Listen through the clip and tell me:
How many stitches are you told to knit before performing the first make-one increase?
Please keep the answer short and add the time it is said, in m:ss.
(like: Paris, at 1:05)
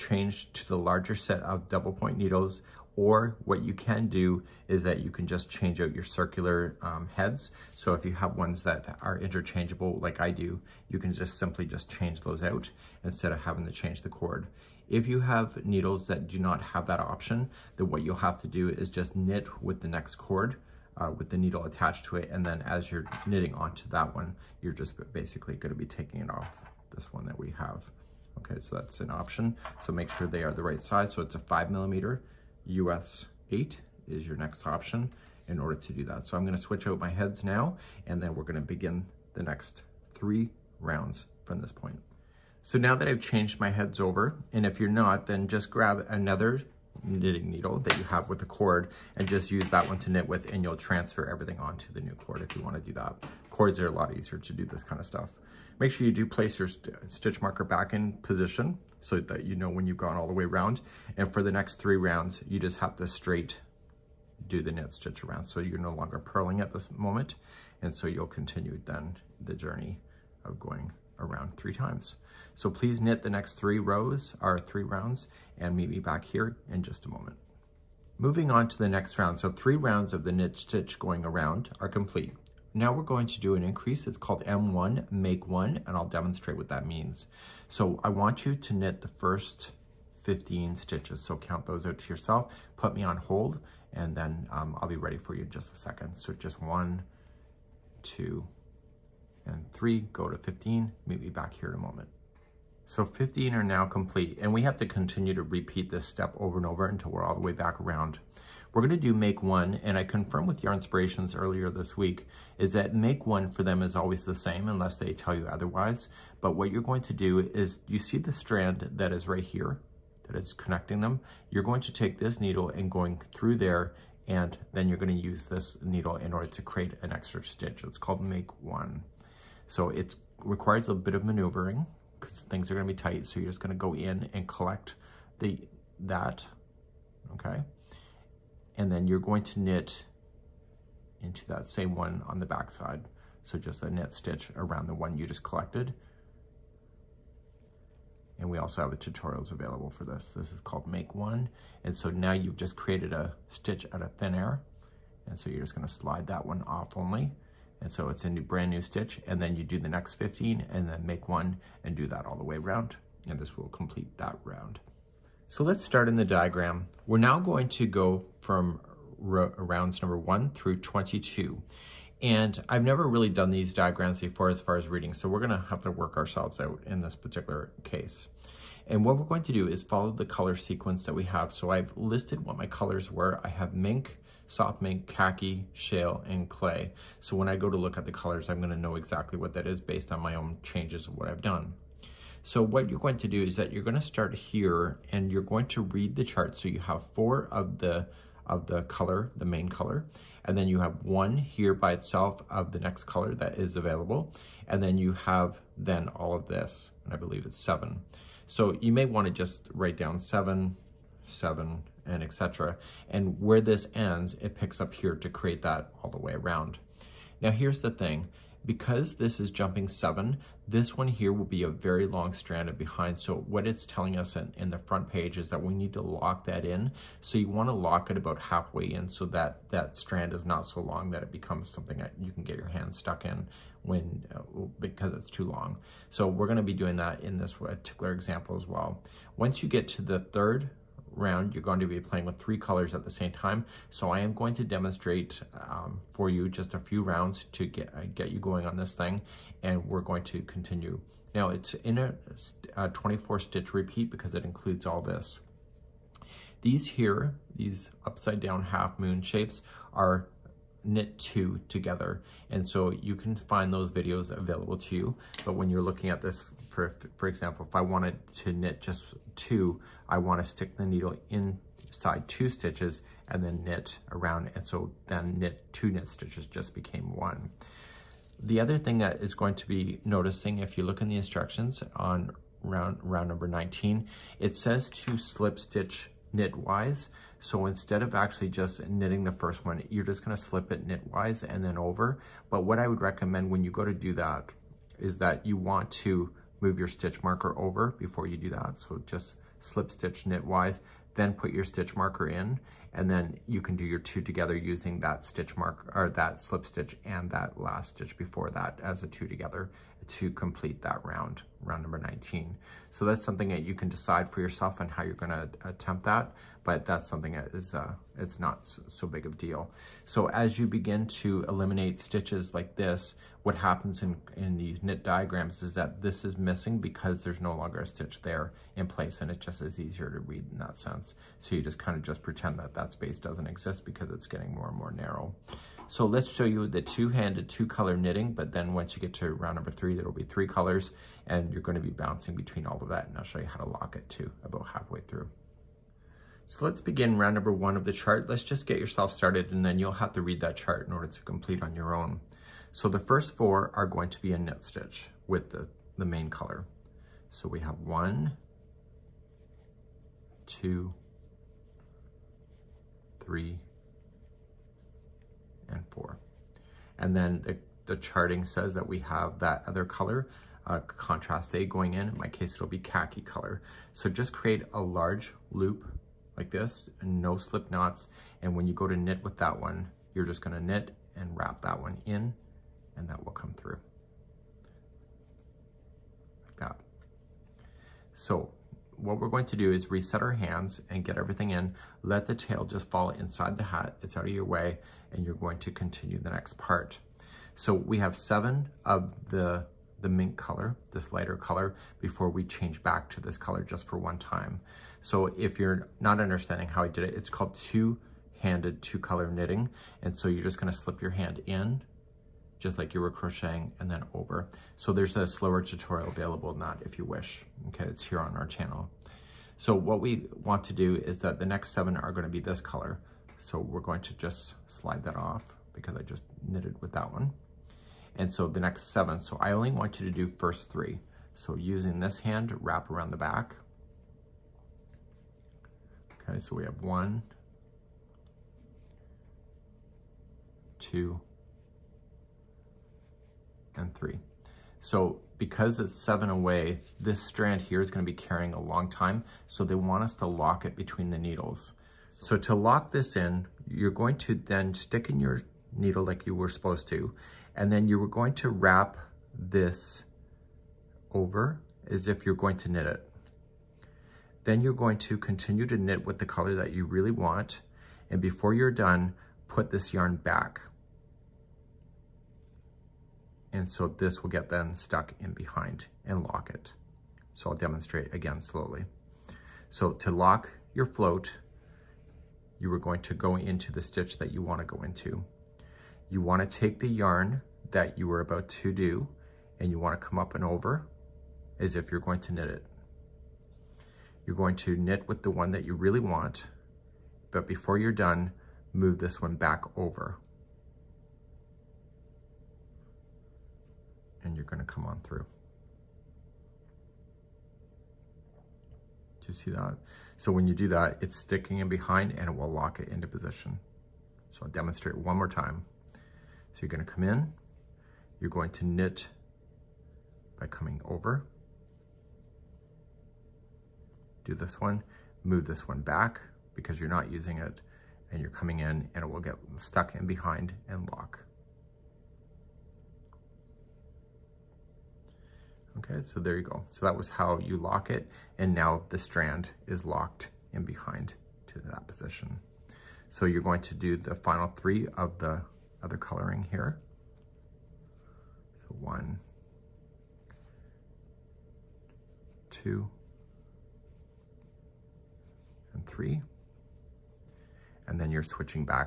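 15, at 1:30.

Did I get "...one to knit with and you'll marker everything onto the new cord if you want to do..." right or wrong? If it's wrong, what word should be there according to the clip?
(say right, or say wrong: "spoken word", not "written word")
wrong: "transfer", not "marker".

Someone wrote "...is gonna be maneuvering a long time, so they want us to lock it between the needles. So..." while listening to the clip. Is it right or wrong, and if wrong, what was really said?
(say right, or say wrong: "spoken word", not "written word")
wrong: "carrying", not "maneuvering".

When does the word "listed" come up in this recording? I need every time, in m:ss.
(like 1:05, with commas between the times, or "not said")
3:01.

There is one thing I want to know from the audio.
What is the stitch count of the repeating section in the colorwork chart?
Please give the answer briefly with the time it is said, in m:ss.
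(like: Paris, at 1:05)
24, at 4:12.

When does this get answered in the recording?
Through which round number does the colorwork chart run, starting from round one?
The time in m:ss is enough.
2:50.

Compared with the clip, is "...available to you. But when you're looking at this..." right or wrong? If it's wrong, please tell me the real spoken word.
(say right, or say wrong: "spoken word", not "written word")
right.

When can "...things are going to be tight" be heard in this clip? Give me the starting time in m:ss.
2:12.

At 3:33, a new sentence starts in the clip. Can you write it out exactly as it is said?
And where this ends, it picks up here to create that all the way around.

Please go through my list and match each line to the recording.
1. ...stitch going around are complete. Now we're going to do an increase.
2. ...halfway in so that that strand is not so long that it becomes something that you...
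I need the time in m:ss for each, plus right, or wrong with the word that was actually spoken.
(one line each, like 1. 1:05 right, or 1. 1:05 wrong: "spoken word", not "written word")
1. 1:20 right
2. 3:48 right.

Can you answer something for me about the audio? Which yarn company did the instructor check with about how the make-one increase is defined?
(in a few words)
Yarnspirations.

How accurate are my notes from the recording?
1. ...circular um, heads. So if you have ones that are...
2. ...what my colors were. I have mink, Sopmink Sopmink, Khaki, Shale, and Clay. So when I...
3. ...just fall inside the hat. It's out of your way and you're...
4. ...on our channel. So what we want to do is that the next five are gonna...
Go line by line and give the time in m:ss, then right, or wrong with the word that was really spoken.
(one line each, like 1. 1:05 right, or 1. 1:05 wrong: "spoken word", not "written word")
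1. 0:06 right
2. 3:02 wrong: "Soft", not "Sopmink"
3. 6:32 right
4. 6:58 wrong: "seven", not "five".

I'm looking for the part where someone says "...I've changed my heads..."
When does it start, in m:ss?
0:43.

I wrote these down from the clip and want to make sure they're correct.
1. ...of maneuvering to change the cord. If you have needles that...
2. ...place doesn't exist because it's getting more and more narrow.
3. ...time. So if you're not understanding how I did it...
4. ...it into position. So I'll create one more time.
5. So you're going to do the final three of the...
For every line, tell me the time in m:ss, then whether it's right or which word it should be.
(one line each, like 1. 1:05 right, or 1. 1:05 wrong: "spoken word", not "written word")
1. 0:13 wrong: "having", not "maneuvering"
2. 5:32 wrong: "space", not "place"
3. 6:44 right
4. 8:32 wrong: "demonstrate", not "create"
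5. 9:03 right.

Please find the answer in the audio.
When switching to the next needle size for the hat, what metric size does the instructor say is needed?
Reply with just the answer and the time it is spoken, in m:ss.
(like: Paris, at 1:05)
5 millimeter, at 0:31.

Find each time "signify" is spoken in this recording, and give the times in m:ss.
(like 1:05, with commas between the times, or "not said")
not said.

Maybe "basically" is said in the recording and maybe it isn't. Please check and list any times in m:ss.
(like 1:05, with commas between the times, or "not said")
0:25.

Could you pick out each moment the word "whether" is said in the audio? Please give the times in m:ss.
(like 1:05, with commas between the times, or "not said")
not said.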